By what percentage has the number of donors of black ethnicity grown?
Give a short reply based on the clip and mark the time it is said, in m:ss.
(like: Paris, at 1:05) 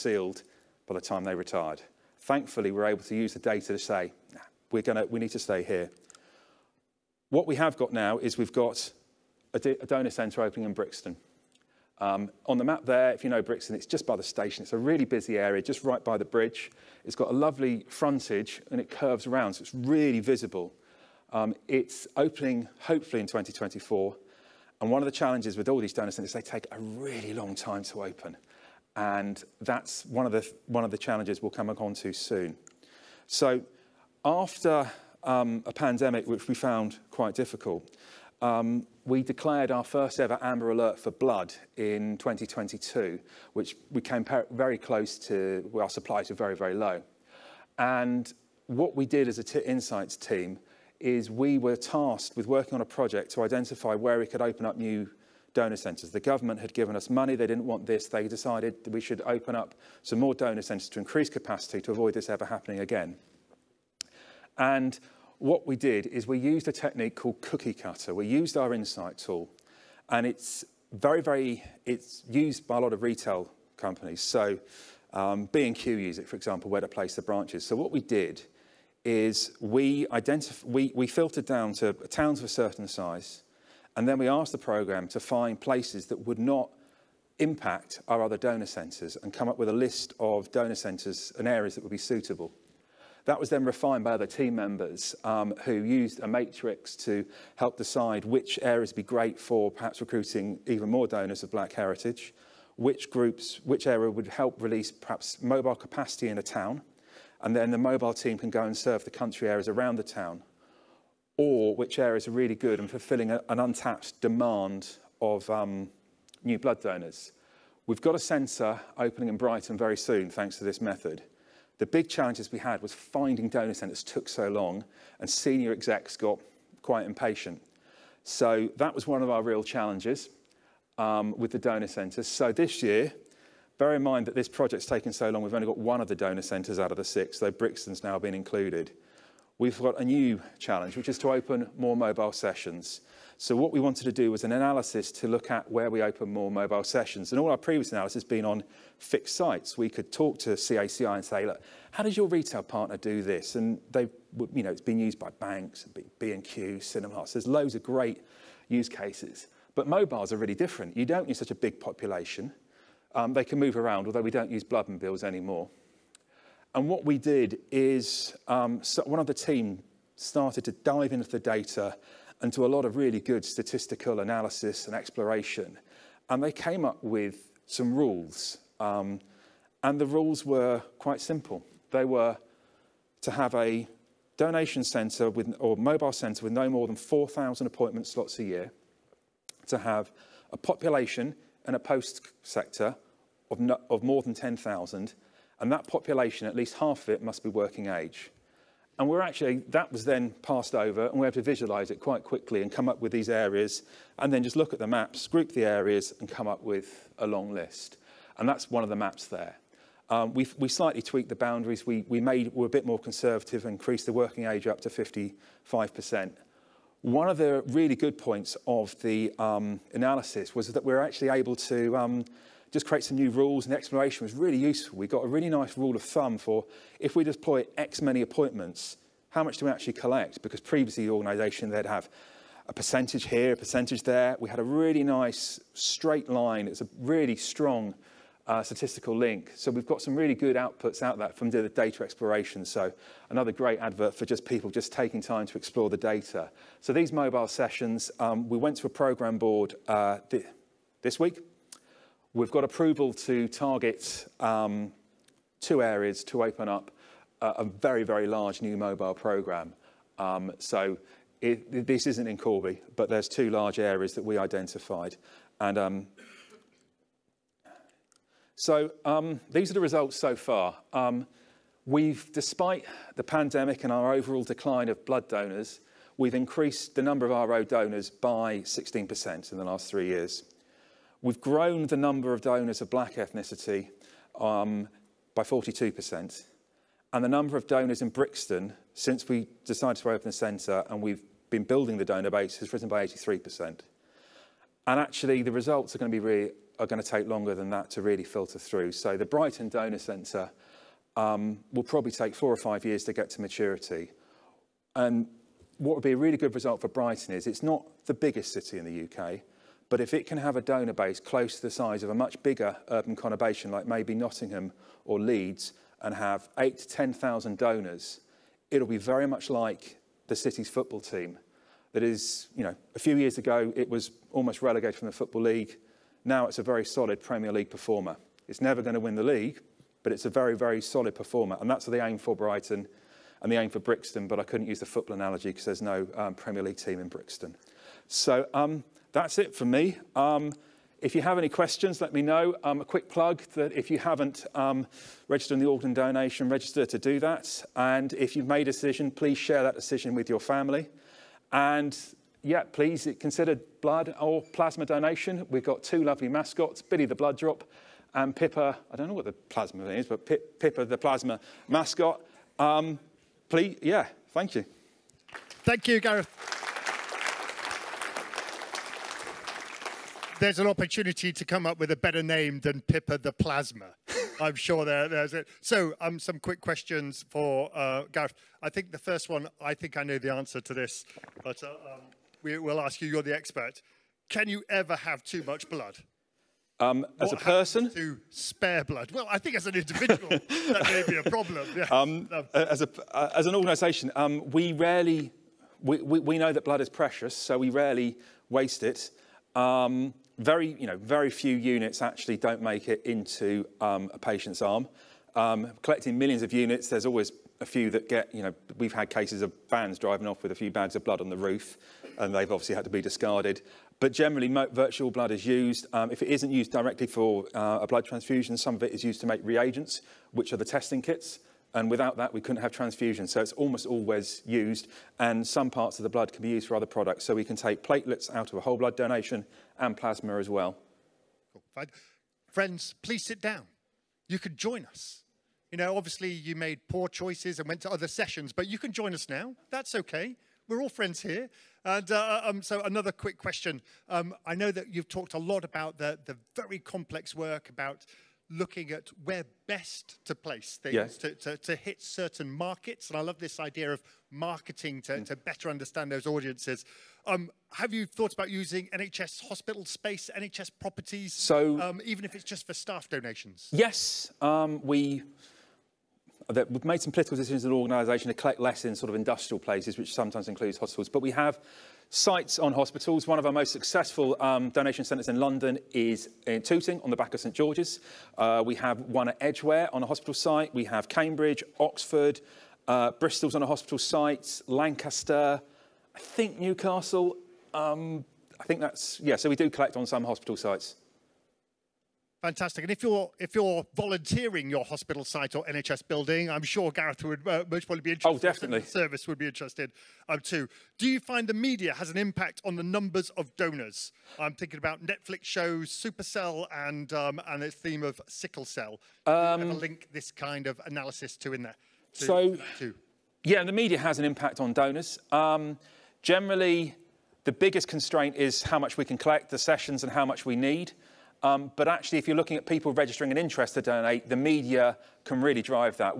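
42%, at 4:45.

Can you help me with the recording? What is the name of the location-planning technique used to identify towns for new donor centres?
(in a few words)
cookie cutter.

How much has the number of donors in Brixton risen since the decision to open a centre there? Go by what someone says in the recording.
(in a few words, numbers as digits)
83%.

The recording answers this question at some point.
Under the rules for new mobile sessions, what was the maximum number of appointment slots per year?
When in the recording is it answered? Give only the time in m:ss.
3:06.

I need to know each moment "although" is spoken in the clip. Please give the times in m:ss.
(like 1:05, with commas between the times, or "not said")
2:44.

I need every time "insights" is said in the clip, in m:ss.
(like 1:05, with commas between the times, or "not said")
0:49, 1:08.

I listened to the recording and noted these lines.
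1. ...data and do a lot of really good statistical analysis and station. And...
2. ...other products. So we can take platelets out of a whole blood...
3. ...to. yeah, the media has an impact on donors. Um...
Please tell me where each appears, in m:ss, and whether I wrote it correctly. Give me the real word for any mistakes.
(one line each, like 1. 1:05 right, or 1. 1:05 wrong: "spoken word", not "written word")
1. 2:51 wrong: "exploration", not "station"
2. 7:06 right
3. 8:32 right.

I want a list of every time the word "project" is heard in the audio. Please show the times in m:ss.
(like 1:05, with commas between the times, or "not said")
0:52, 2:14.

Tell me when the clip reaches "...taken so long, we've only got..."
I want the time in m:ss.
2:14.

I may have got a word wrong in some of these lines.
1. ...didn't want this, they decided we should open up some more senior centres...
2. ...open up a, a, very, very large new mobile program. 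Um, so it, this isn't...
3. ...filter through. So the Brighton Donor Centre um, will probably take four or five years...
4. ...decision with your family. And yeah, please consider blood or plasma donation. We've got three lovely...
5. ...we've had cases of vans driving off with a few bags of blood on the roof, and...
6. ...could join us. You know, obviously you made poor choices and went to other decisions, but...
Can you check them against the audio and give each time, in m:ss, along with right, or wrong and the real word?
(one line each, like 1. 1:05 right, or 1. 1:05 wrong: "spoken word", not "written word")
1. 0:57 wrong: "donor", not "senior"
2. 4:16 right
3. 4:58 right
4. 5:49 wrong: "two", not "three"
5. 6:48 right
6. 7:14 wrong: "sessions", not "decisions".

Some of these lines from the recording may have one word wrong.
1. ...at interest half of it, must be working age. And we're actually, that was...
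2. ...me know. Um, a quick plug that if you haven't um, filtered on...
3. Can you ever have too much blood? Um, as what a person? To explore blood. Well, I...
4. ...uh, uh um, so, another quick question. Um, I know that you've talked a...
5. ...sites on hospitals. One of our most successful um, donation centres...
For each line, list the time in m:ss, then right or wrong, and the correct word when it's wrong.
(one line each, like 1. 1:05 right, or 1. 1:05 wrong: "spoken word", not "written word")
1. 3:16 wrong: "least", not "interest"
2. 5:42 wrong: "registered", not "filtered"
3. 6:24 wrong: "spare", not "explore"
4. 7:22 right
5. 7:52 right.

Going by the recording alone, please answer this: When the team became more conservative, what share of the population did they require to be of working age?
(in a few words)
55%.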